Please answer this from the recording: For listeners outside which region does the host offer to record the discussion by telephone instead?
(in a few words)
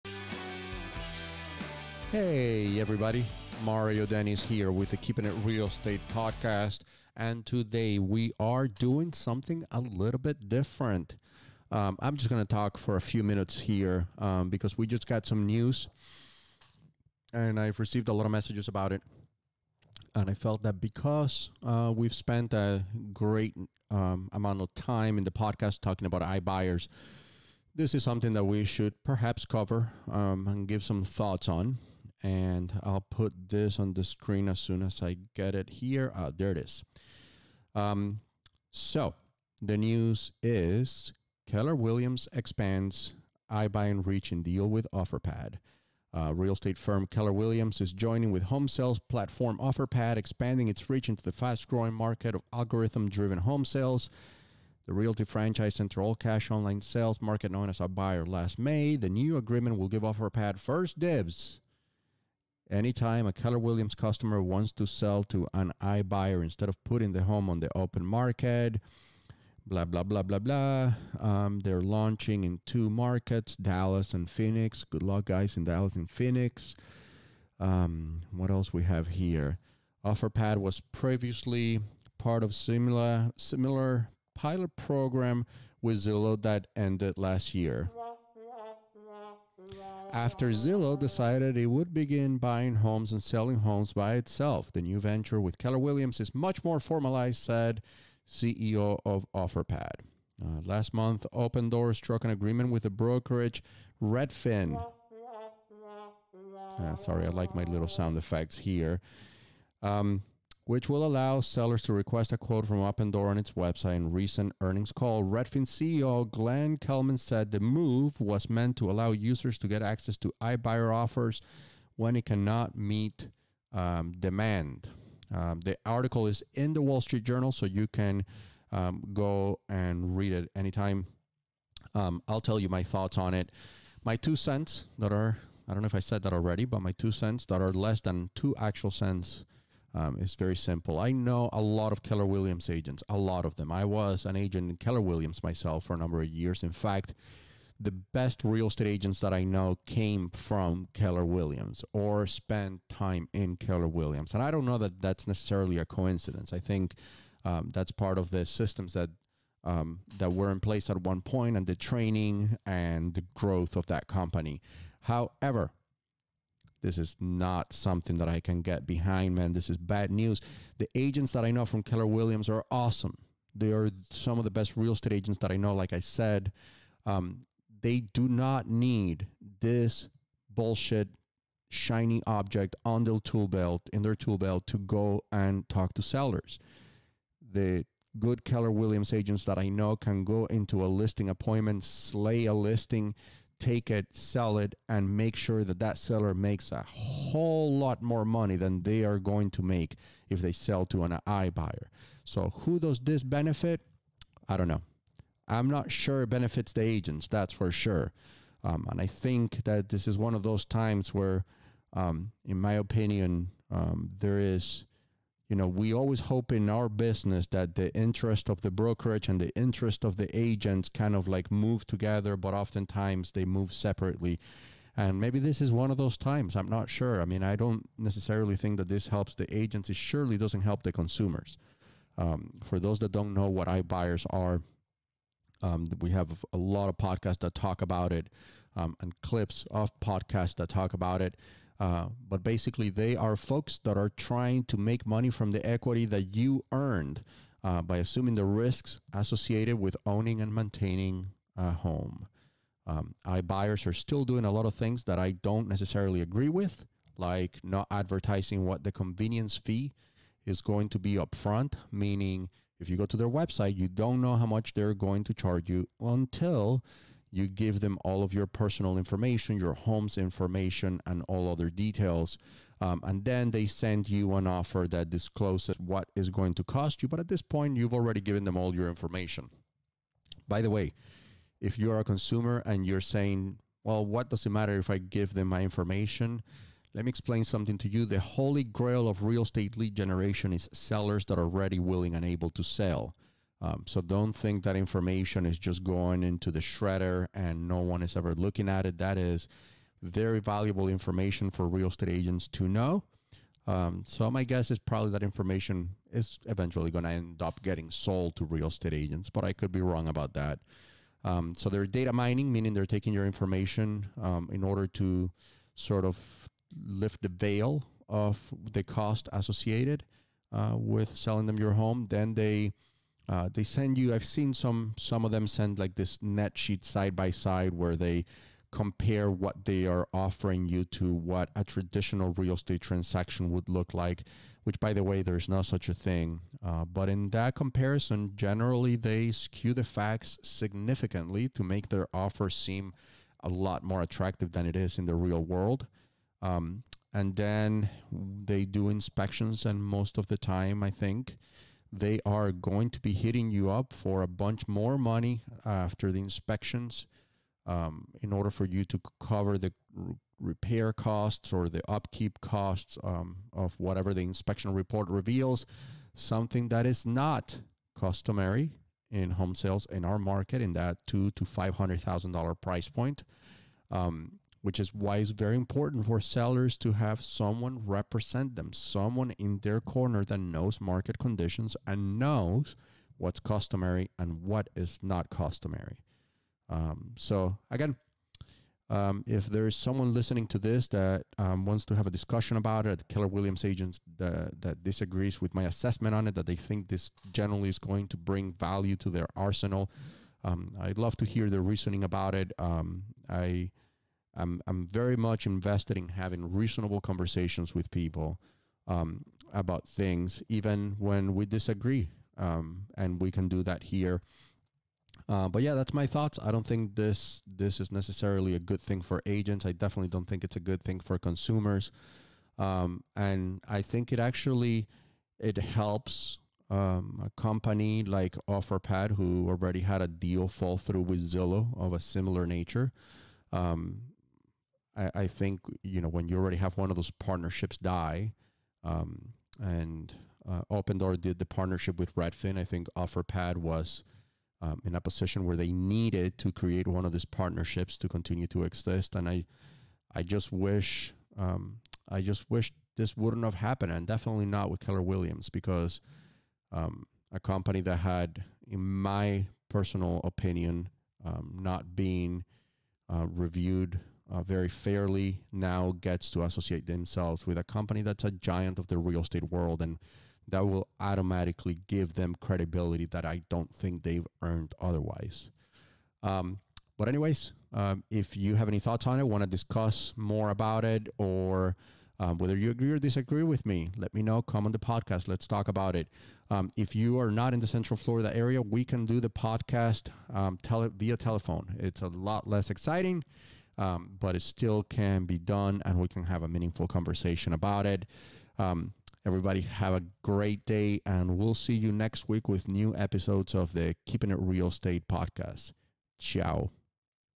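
Central Florida.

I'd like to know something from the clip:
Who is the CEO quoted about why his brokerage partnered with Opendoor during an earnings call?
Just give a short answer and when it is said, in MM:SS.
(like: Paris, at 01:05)
Glenn Kelman, at 01:56.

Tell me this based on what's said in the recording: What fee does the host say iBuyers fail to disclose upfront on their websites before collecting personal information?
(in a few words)
convenience fee.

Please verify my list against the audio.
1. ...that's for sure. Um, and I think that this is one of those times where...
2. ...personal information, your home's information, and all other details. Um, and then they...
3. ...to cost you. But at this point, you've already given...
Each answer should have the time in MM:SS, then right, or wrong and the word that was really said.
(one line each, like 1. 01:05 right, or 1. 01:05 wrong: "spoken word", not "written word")
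1. 03:27 right
2. 04:28 right
3. 04:36 right.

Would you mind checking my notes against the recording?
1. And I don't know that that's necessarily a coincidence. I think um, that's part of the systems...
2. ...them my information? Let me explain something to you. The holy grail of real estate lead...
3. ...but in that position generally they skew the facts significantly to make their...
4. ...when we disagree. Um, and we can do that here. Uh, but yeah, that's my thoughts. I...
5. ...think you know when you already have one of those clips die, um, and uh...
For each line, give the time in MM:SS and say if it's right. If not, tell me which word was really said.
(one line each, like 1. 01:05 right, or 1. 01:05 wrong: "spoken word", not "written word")
1. 02:34 right
2. 04:45 right
3. 05:36 wrong: "comparison", not "position"
4. 06:50 right
5. 07:15 wrong: "partnerships", not "clips".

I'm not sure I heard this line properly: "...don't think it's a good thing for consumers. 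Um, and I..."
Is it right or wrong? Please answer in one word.
right.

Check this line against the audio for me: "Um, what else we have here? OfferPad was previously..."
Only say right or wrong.
right.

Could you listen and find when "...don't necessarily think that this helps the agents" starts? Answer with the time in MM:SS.
03:47.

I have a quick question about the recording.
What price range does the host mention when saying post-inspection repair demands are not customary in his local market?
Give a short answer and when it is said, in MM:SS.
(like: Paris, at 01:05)
$200,000 to $500,000, at 06:11.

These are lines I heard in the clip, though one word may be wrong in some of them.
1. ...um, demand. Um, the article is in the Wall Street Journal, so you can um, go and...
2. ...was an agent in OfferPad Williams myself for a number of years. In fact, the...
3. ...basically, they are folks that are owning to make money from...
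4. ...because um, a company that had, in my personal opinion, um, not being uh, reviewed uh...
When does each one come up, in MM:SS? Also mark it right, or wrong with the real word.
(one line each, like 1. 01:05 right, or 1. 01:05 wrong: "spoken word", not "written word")
1. 02:03 right
2. 02:23 wrong: "Keller", not "OfferPad"
3. 04:02 wrong: "trying", not "owning"
4. 07:35 right.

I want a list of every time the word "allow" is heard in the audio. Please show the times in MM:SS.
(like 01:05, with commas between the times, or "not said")
01:51, 01:58.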